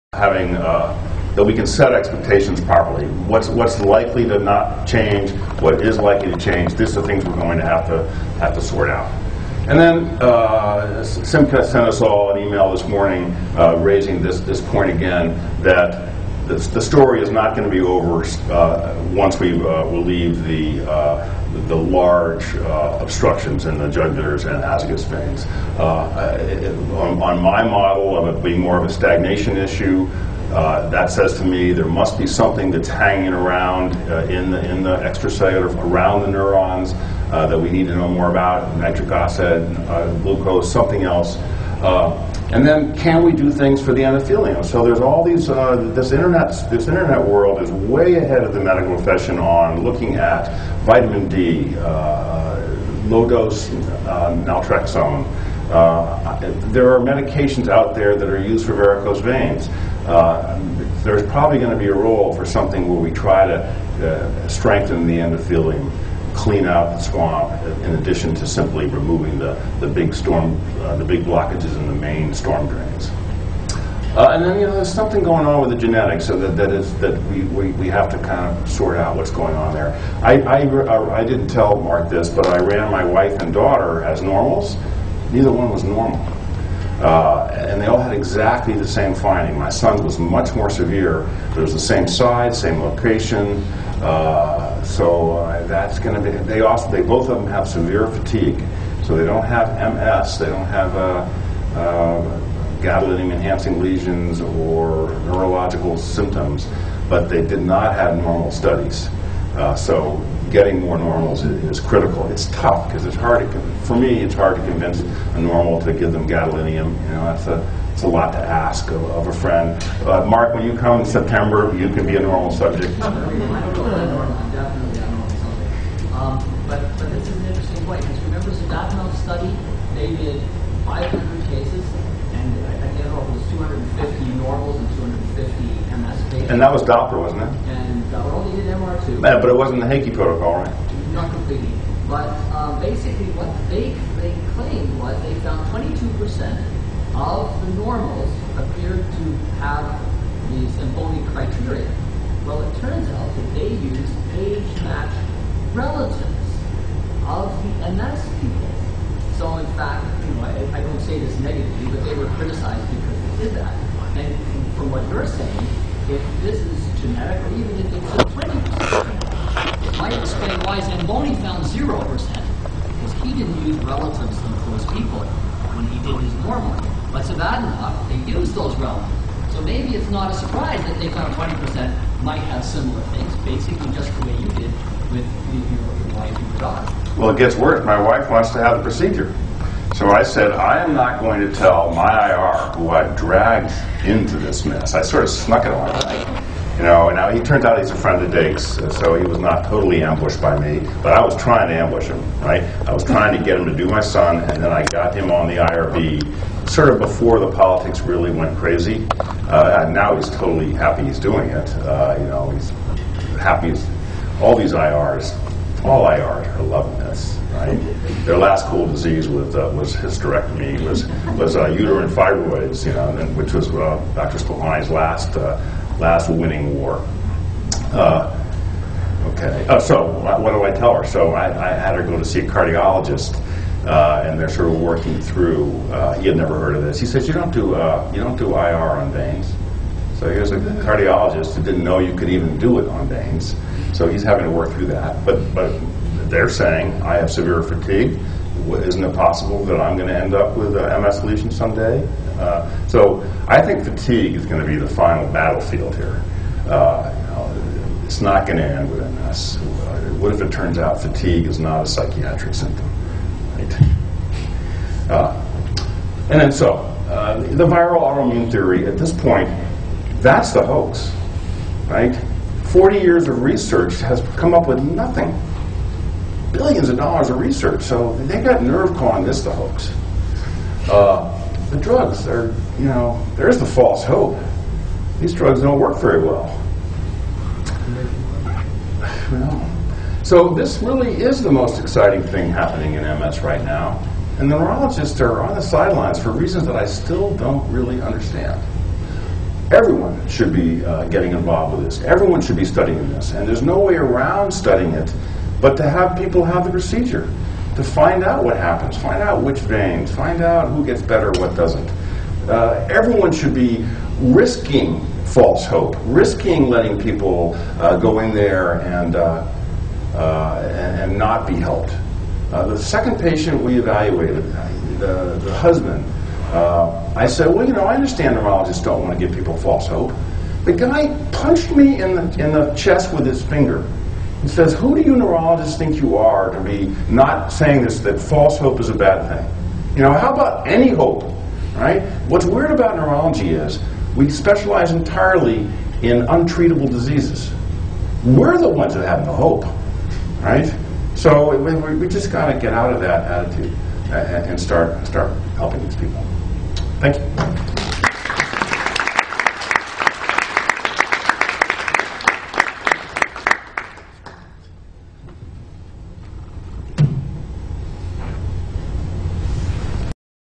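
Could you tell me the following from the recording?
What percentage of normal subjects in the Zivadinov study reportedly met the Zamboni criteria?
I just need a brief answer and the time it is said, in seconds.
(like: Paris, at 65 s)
22 percent, at 145 s.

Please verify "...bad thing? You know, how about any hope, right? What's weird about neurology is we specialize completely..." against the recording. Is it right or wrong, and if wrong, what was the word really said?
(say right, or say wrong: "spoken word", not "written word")
wrong: "entirely", not "completely".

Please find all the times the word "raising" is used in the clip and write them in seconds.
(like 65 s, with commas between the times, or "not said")
13 s.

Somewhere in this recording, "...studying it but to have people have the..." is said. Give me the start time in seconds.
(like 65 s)
304 s.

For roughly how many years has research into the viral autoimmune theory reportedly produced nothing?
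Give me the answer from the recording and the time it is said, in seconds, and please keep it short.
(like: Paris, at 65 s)
40, at 272 s.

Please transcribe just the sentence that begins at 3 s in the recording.
What's what's likely to not change?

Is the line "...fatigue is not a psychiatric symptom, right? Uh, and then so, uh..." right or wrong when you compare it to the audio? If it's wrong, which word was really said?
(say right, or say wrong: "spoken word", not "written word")
right.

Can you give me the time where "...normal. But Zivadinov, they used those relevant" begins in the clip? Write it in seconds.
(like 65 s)
176 s.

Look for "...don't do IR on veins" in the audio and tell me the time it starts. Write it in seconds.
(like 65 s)
238 s.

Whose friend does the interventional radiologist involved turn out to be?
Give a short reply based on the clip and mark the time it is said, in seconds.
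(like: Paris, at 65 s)
Dake, at 198 s.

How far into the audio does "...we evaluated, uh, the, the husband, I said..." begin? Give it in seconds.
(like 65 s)
323 s.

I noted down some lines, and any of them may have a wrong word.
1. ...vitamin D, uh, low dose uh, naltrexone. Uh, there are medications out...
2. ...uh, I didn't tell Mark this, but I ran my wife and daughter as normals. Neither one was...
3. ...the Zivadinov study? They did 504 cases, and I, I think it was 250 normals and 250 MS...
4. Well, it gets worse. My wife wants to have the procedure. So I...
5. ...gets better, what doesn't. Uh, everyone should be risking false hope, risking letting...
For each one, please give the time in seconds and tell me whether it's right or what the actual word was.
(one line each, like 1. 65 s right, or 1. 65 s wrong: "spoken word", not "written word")
1. 50 s right
2. 80 s right
3. 128 s wrong: "500", not "504"
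4. 187 s right
5. 310 s right.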